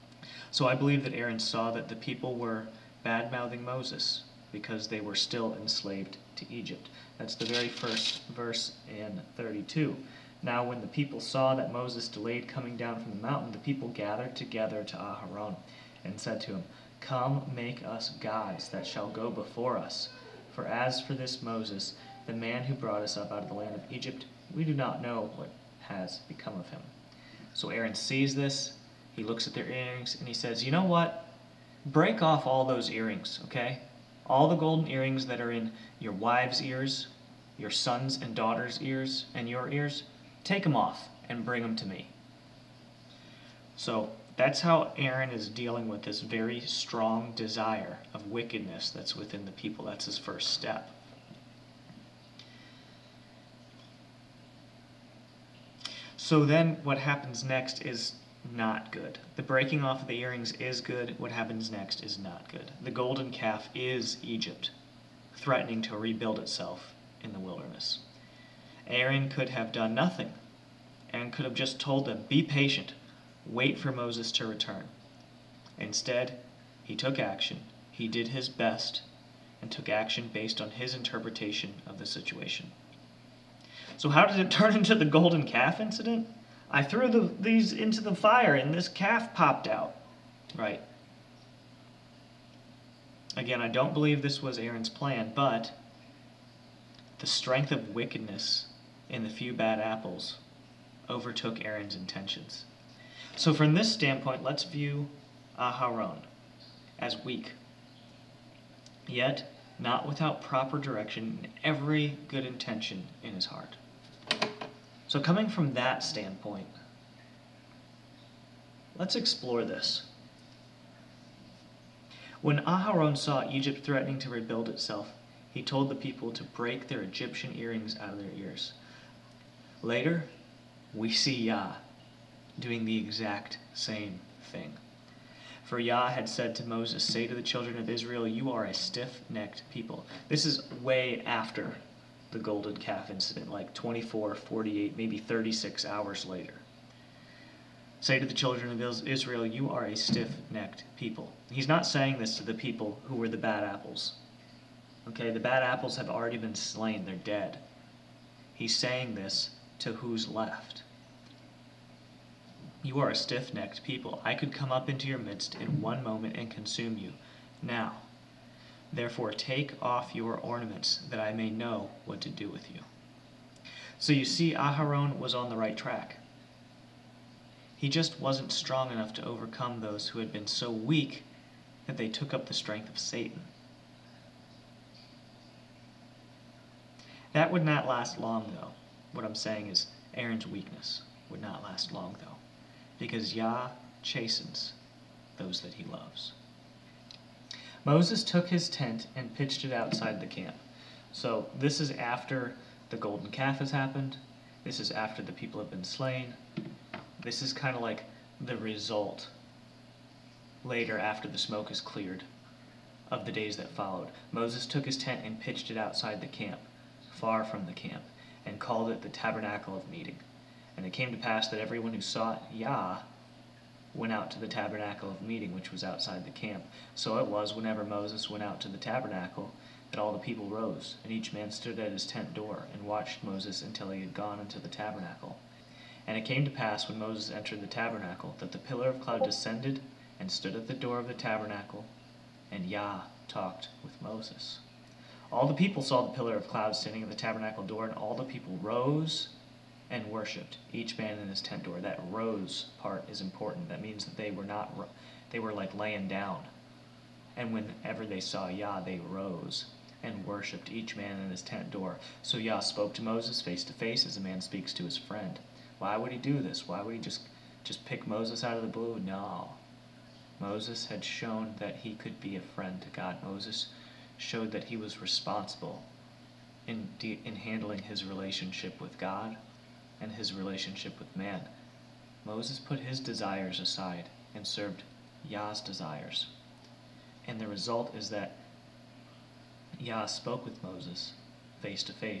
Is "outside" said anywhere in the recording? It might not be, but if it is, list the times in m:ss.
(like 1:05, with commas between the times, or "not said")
3:19, 3:35, 3:45.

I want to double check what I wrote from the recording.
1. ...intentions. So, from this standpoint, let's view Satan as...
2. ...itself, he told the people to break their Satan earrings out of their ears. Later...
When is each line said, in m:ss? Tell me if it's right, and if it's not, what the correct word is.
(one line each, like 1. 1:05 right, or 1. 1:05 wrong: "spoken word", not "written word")
1. 1:41 wrong: "Aharon", not "Satan"
2. 2:04 wrong: "Egyptian", not "Satan".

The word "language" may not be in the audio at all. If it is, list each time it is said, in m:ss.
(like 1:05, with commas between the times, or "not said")
not said.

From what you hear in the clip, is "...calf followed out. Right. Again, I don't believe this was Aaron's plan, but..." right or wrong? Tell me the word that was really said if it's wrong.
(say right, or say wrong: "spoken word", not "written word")
wrong: "popped", not "followed".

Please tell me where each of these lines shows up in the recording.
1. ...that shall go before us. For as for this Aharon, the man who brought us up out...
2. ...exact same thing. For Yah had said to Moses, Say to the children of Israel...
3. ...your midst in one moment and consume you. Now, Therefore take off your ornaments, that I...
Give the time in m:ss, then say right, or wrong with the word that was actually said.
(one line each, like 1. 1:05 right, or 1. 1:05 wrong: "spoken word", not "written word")
1. 0:18 wrong: "Moses", not "Aharon"
2. 2:12 right
3. 2:45 right.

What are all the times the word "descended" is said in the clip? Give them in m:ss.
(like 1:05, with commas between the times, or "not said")
3:59.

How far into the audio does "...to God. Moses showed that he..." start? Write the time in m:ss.
4:32.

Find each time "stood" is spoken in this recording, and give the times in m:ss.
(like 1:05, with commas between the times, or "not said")
3:51, 4:00.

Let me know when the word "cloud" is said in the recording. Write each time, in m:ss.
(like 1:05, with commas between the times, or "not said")
3:58, 4:06.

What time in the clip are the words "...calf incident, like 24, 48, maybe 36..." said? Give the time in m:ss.
2:22.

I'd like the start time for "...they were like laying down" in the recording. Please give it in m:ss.
4:15.